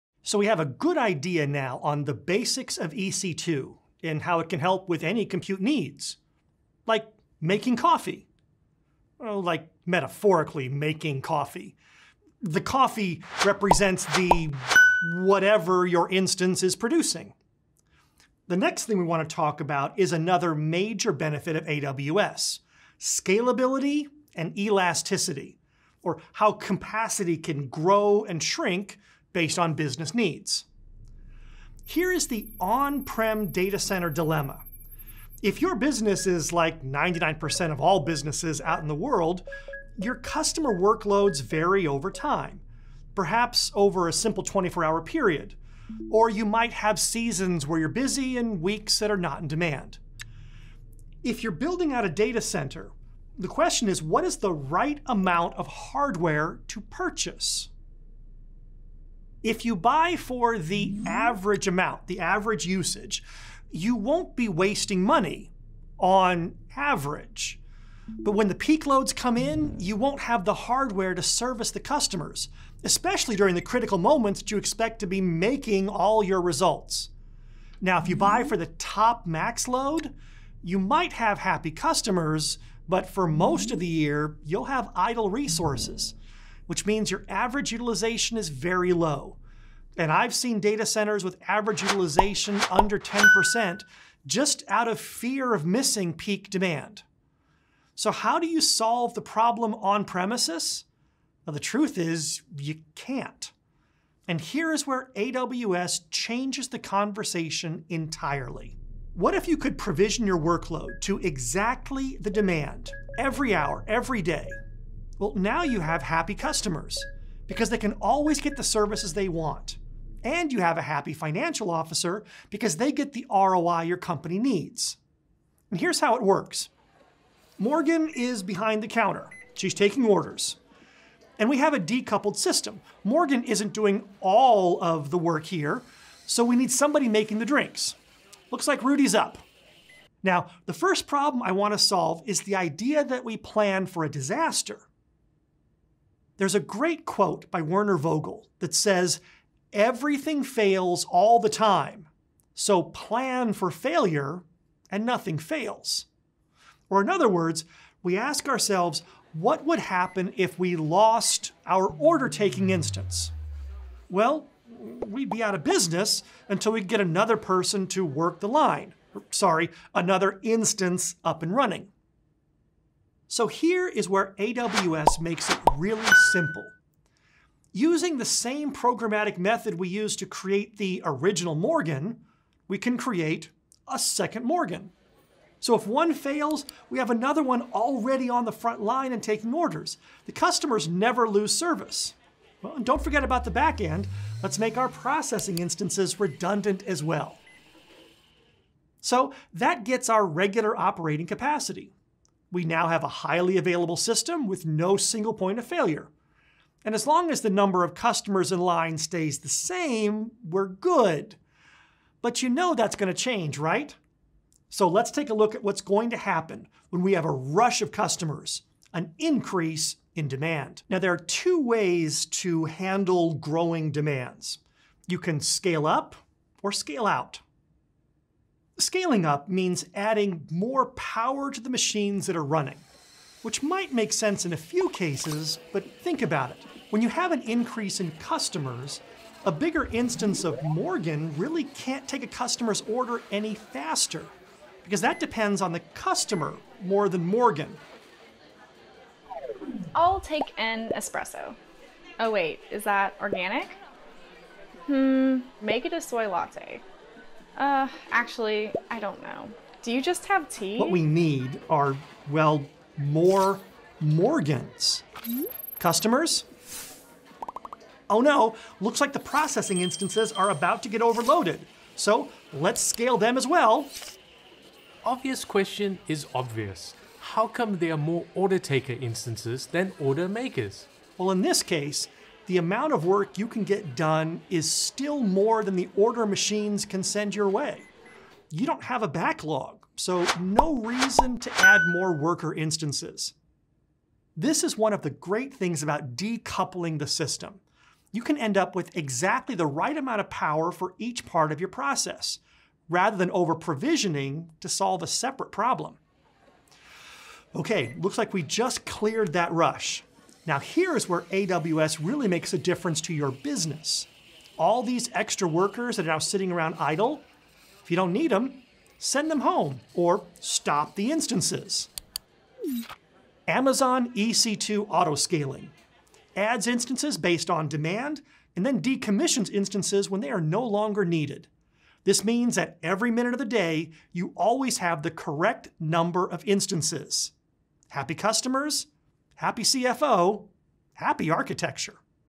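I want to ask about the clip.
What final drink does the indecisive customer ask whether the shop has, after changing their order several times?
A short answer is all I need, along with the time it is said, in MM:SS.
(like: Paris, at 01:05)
tea, at 04:20.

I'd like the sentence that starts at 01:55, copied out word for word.
Well, now you have happy customers because they can always get the services they want.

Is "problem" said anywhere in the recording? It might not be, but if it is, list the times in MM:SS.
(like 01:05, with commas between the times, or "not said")
01:39, 02:21, 05:05.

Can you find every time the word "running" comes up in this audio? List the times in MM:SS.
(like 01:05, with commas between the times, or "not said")
02:51, 03:52.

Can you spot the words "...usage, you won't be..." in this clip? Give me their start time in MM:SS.
01:02.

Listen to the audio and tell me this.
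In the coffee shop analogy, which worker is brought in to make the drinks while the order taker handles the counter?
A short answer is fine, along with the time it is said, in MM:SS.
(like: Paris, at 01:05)
Rudy, at 02:18.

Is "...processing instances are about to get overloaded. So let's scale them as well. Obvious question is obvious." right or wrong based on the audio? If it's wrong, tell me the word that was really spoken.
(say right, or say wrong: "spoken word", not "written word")
right.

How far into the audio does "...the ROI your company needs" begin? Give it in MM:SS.
02:03.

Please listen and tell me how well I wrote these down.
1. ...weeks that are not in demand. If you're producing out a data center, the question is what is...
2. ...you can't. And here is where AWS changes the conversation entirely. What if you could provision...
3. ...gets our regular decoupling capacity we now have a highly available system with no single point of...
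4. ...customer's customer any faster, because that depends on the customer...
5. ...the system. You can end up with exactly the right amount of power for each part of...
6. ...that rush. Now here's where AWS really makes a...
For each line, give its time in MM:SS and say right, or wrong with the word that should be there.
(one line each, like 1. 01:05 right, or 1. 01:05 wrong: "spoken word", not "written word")
1. 00:48 wrong: "building", not "producing"
2. 01:42 right
3. 03:19 wrong: "operating", not "decoupling"
4. 04:02 wrong: "order", not "customer"
5. 04:56 right
6. 05:09 right.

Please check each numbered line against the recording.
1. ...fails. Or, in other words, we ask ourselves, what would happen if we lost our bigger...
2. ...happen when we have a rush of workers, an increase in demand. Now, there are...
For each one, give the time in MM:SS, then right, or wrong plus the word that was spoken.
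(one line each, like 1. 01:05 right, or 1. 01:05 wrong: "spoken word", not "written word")
1. 02:35 wrong: "order", not "bigger"
2. 03:36 wrong: "customers", not "workers".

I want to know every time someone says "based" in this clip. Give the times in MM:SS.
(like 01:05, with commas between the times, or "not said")
00:29, 05:27.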